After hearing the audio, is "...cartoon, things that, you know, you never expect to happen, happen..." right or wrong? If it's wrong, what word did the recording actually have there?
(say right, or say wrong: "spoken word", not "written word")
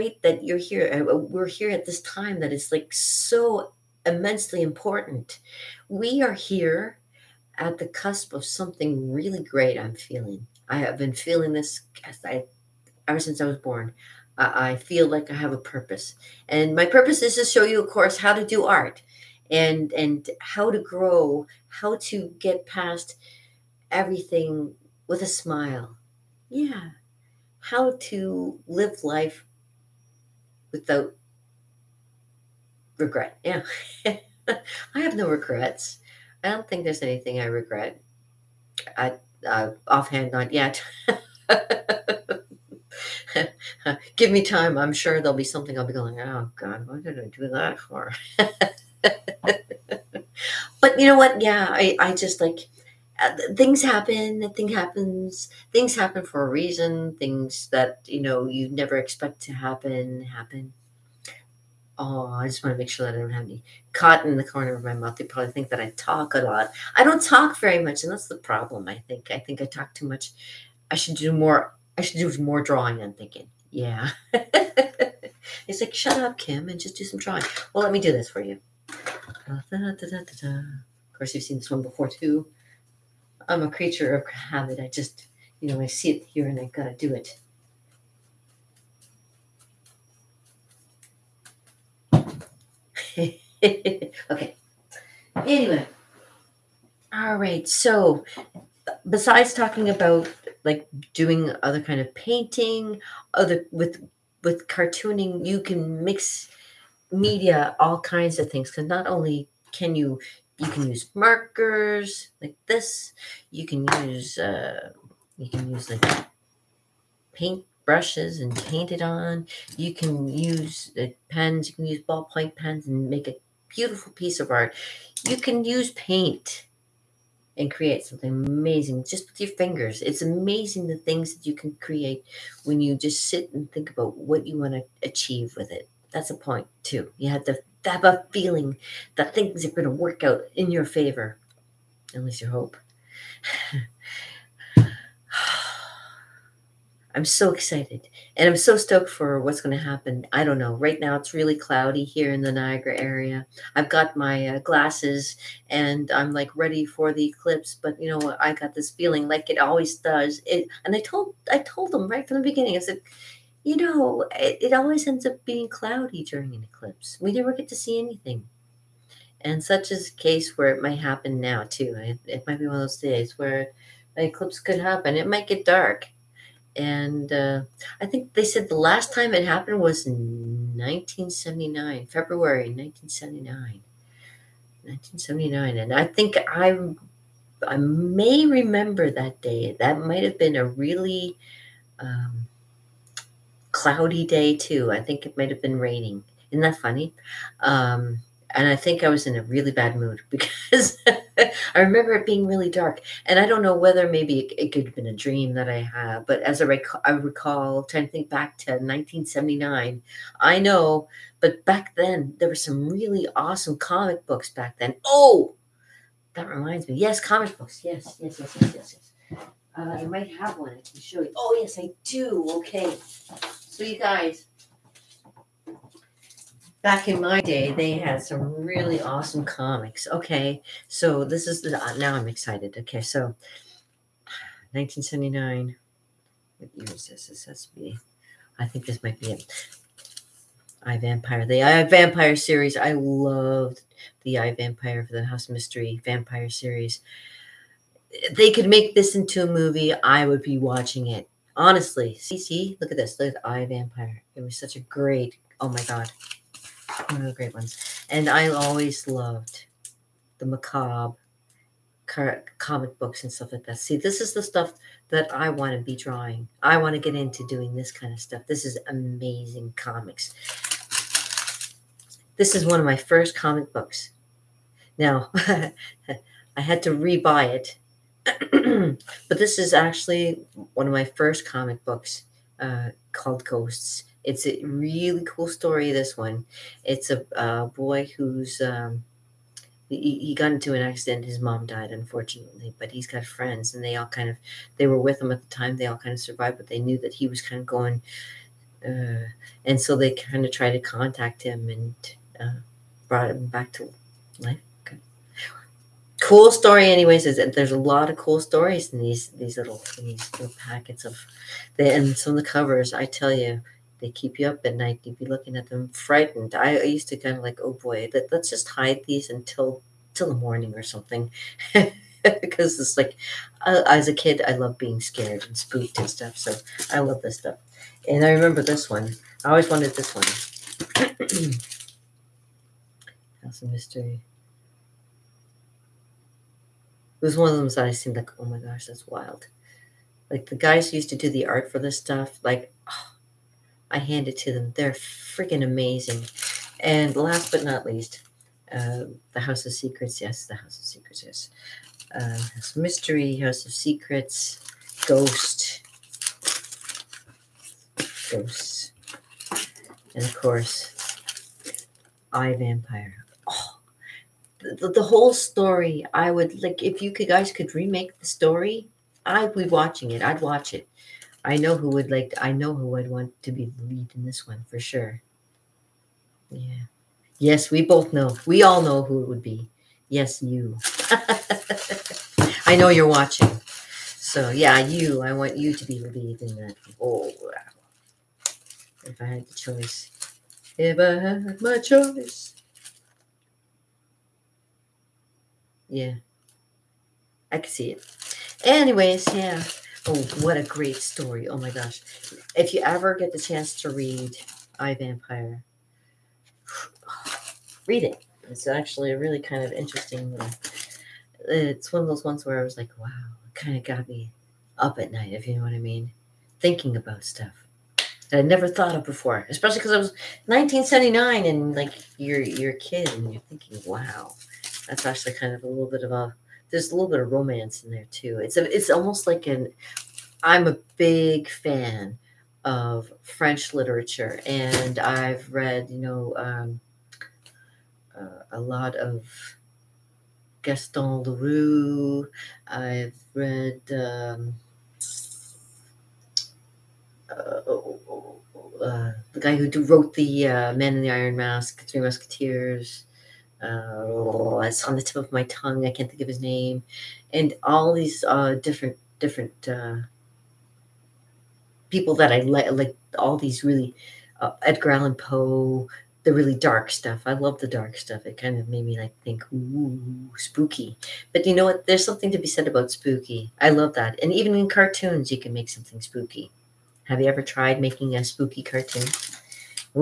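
wrong: "reason", not "cartoon".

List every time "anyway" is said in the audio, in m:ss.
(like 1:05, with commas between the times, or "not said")
1:35, 5:06, 6:38.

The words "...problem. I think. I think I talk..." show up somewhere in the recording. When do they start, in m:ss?
1:08.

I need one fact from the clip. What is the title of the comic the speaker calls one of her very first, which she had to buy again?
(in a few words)
Ghosts.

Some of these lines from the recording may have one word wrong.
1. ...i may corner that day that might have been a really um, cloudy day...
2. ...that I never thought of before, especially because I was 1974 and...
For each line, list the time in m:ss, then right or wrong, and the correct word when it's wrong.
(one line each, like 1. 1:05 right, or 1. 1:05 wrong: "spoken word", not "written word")
1. 3:07 wrong: "remember", not "corner"
2. 6:58 wrong: "1979", not "1974".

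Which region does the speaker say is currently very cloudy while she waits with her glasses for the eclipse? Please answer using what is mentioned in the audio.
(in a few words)
Niagara.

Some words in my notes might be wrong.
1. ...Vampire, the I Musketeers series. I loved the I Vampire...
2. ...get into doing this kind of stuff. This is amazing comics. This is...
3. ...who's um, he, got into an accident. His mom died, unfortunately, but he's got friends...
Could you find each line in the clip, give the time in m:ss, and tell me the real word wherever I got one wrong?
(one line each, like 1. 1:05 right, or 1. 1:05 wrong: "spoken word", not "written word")
1. 4:00 wrong: "Vampire", not "Musketeers"
2. 4:27 right
3. 4:48 right.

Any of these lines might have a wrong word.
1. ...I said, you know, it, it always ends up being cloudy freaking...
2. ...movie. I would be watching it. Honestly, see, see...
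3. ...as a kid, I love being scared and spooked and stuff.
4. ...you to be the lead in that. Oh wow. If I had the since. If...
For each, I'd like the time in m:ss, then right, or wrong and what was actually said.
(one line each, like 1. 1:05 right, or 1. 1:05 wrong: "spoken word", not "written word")
1. 2:42 wrong: "during", not "freaking"
2. 4:09 right
3. 5:23 right
4. 6:25 wrong: "choice", not "since".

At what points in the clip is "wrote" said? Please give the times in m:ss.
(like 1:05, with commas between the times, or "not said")
7:29.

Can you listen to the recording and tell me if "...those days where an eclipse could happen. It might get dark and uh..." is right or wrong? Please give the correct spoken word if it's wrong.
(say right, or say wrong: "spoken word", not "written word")
right.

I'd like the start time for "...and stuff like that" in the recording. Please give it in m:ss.
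4:23.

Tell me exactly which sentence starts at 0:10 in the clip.
I have been feeling this I, ever since I was born.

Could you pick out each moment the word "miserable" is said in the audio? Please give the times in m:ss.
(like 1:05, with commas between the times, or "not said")
not said.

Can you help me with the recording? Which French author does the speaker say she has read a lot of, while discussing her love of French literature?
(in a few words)
Gaston Leroux.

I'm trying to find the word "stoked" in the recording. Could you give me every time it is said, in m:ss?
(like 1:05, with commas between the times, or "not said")
2:28.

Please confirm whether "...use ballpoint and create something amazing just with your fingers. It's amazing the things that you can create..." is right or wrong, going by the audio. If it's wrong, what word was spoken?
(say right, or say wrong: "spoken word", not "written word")
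wrong: "paint", not "ballpoint".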